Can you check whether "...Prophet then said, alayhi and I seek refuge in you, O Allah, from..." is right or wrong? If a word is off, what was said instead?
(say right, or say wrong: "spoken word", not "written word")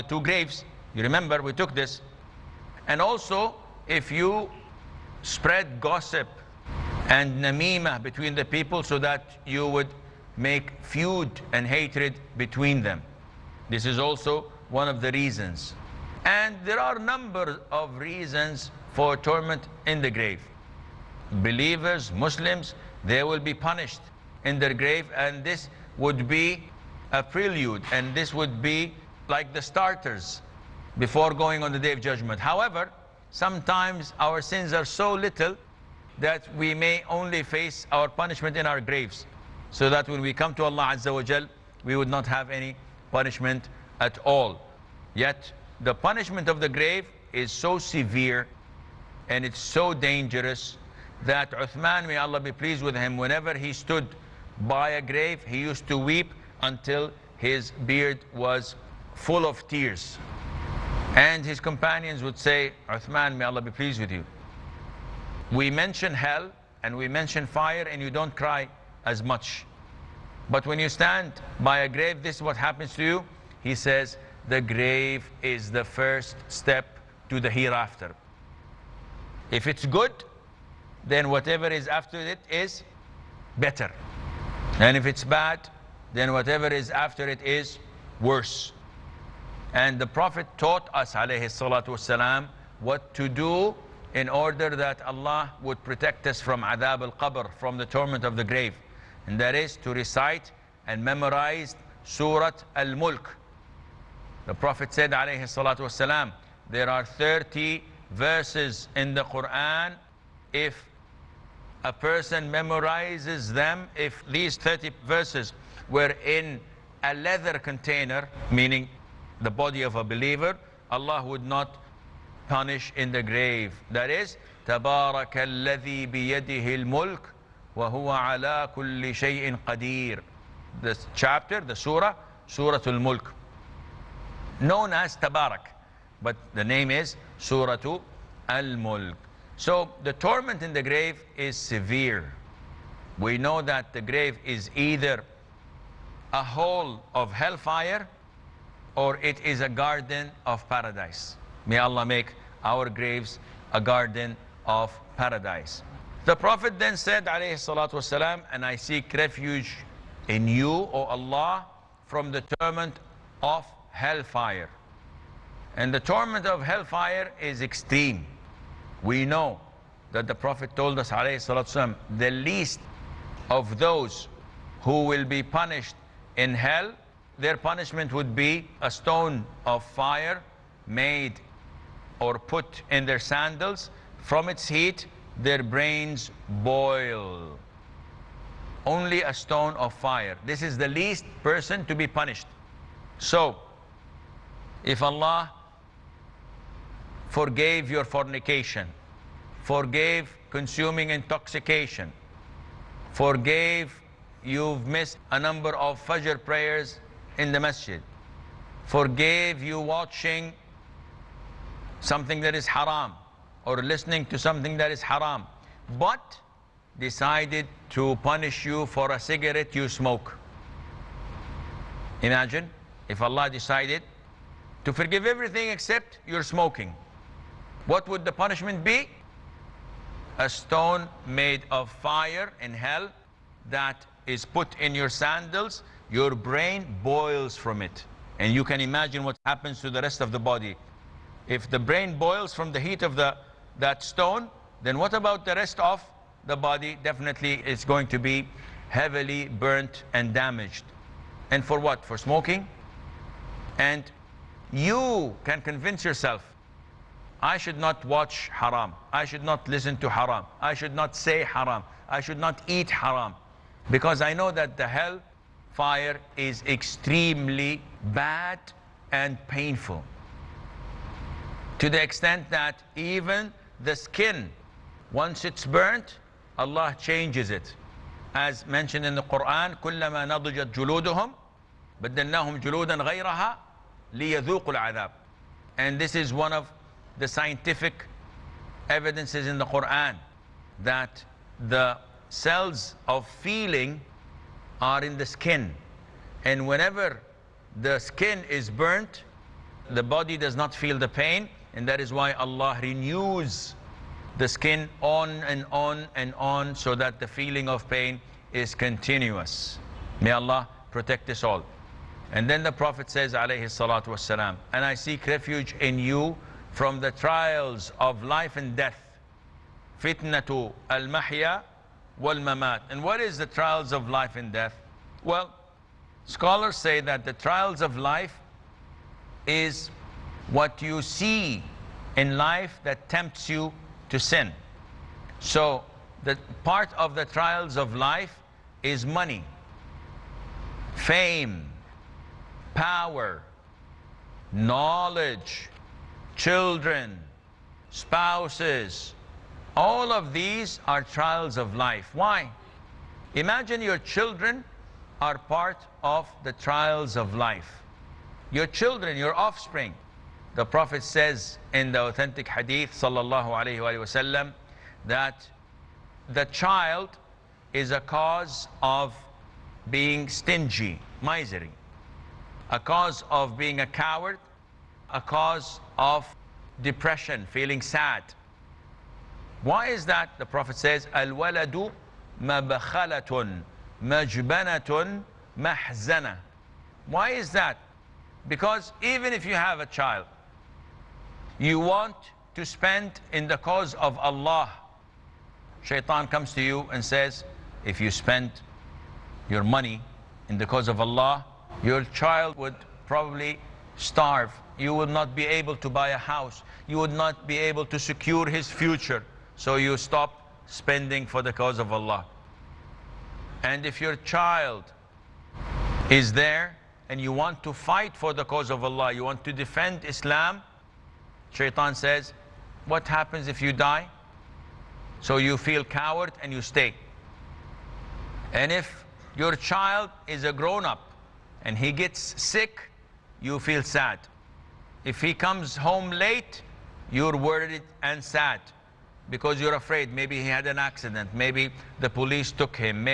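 right.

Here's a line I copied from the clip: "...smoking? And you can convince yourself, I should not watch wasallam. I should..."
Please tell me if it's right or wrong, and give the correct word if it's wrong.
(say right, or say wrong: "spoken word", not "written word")
wrong: "haram", not "wasallam".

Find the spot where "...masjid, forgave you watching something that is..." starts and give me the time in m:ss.
3:27.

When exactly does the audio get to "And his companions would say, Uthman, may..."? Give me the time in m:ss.
1:01.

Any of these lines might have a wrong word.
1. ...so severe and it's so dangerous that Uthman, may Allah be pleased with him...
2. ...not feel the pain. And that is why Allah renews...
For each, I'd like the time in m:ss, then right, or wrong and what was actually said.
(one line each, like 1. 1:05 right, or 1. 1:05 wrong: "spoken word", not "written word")
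1. 0:47 right
2. 5:00 right.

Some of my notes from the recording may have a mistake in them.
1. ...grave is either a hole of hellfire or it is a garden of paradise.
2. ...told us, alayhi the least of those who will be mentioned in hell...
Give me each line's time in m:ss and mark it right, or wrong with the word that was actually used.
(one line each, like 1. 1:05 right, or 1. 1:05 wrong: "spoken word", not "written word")
1. 2:24 right
2. 2:50 wrong: "punished", not "mentioned".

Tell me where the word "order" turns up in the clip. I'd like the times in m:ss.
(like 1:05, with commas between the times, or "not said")
1:34.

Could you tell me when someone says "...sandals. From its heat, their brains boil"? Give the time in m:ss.
3:03.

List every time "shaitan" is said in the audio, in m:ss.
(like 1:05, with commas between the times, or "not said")
6:35, 7:01.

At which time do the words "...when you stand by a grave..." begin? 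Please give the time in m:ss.
1:10.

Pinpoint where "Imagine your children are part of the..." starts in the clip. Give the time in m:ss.
5:53.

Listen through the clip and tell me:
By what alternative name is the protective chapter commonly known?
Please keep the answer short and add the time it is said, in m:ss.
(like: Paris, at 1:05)
Tabarak, at 2:15.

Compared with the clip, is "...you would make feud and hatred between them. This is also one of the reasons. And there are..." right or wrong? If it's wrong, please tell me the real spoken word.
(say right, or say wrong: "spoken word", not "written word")
right.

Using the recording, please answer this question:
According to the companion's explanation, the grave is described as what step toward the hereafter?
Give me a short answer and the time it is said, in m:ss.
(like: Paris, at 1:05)
The first step, at 1:15.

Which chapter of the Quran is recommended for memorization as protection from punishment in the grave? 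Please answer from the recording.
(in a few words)
Surat Al-Mulk.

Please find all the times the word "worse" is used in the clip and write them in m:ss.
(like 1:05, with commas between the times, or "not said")
1:28.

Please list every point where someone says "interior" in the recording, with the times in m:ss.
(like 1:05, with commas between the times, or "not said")
not said.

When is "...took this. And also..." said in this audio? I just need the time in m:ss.
0:01.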